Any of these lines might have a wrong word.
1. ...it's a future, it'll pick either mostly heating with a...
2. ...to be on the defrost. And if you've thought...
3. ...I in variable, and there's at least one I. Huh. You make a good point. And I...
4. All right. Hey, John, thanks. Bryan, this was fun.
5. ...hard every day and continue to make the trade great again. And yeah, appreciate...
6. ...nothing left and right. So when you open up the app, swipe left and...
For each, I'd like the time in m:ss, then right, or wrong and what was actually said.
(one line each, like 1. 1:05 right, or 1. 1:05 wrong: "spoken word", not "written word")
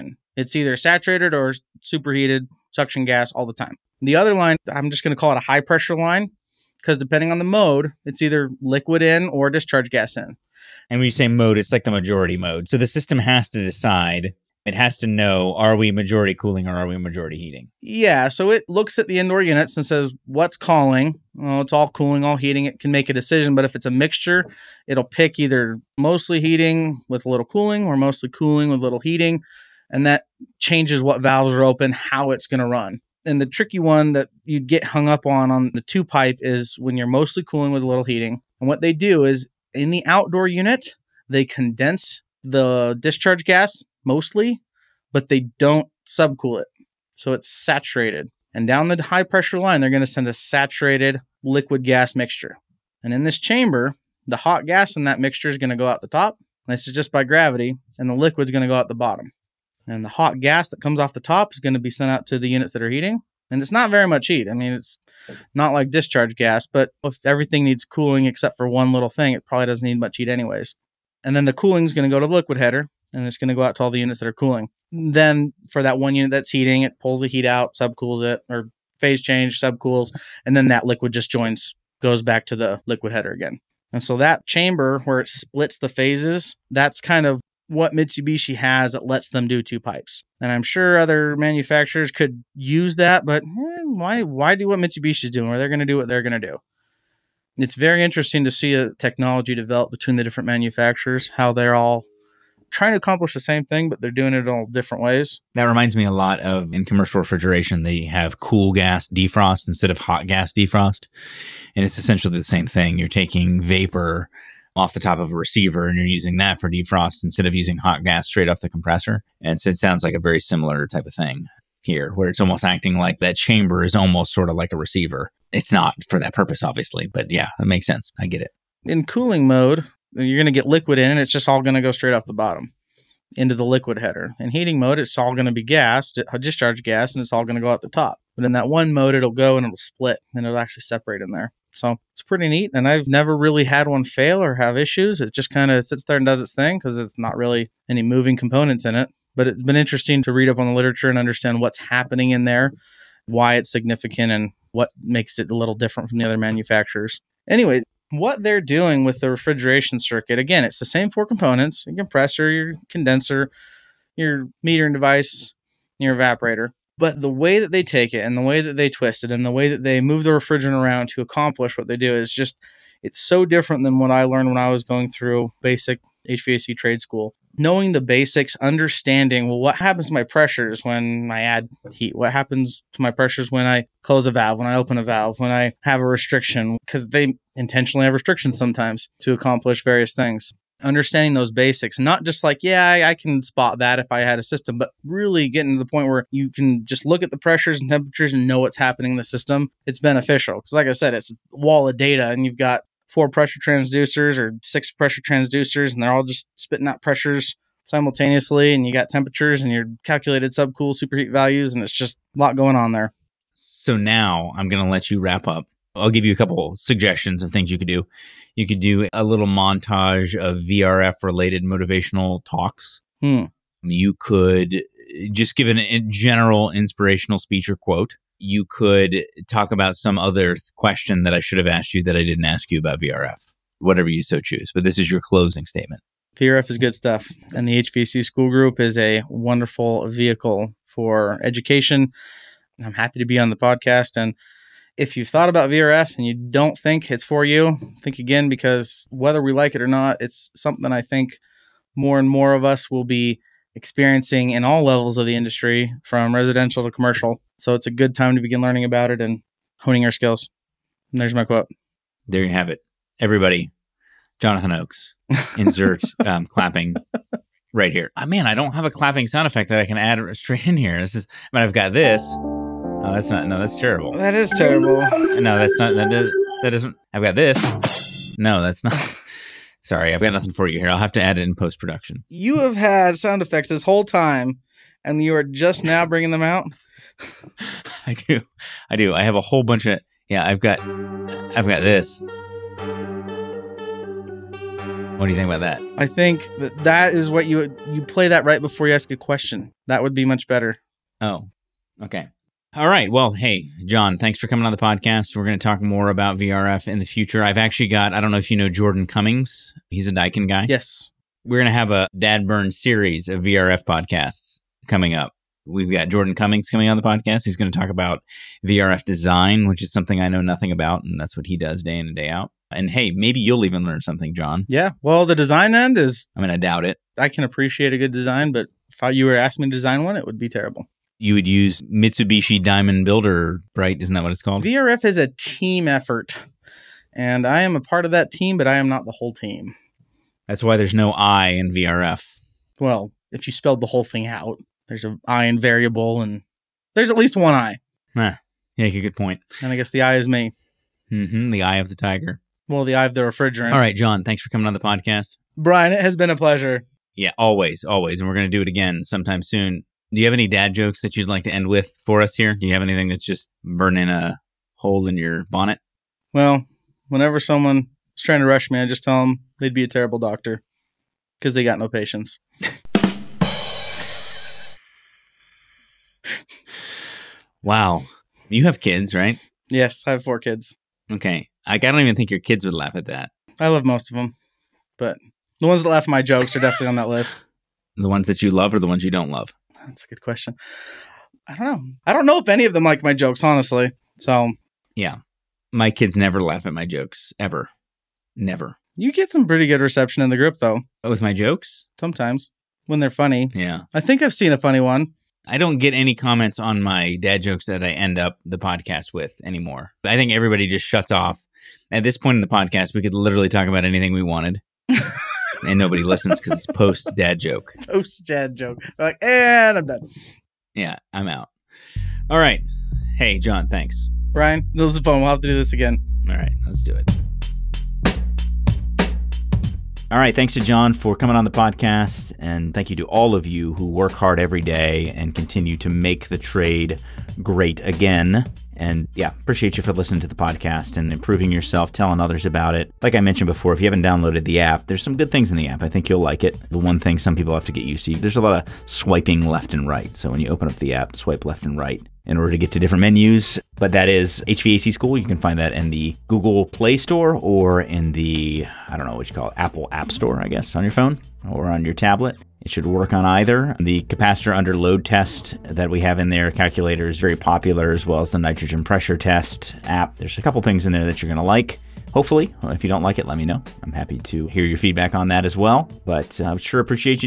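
1. 0:23 wrong: "mixture", not "future"
2. 4:03 wrong: "podcast", not "defrost"
3. 5:45 right
4. 7:02 right
5. 7:14 right
6. 7:28 wrong: "swiping", not "nothing".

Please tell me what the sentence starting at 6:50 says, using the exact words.
I think everybody just shuts off.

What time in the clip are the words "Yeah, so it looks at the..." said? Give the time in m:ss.
0:17.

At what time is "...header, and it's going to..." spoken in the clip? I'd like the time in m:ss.
1:12.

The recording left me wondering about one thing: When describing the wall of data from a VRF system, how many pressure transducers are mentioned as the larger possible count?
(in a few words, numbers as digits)
6.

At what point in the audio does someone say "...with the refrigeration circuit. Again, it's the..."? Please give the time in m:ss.
2:39.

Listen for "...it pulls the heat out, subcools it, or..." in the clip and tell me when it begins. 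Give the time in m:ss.
1:16.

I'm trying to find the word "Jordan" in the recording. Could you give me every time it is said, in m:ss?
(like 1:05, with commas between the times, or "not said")
5:08, 5:16.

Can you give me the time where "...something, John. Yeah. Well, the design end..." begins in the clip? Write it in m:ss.
5:24.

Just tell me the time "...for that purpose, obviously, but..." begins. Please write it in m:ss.
2:06.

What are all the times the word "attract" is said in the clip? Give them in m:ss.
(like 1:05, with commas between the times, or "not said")
not said.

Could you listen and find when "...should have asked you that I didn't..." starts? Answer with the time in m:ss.
3:51.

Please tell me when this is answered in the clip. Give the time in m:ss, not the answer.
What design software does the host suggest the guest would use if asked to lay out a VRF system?
5:32.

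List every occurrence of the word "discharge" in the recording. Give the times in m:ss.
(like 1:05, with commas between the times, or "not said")
0:09, 0:43, 1:05, 2:16.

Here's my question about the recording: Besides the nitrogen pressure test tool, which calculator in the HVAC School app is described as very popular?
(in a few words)
capacitor under load test.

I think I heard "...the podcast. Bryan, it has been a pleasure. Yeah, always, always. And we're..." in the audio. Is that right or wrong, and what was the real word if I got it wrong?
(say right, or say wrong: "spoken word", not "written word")
right.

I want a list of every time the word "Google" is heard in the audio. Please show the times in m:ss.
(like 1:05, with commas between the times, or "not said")
7:36.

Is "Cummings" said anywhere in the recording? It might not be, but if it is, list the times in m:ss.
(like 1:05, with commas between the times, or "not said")
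5:09, 5:16.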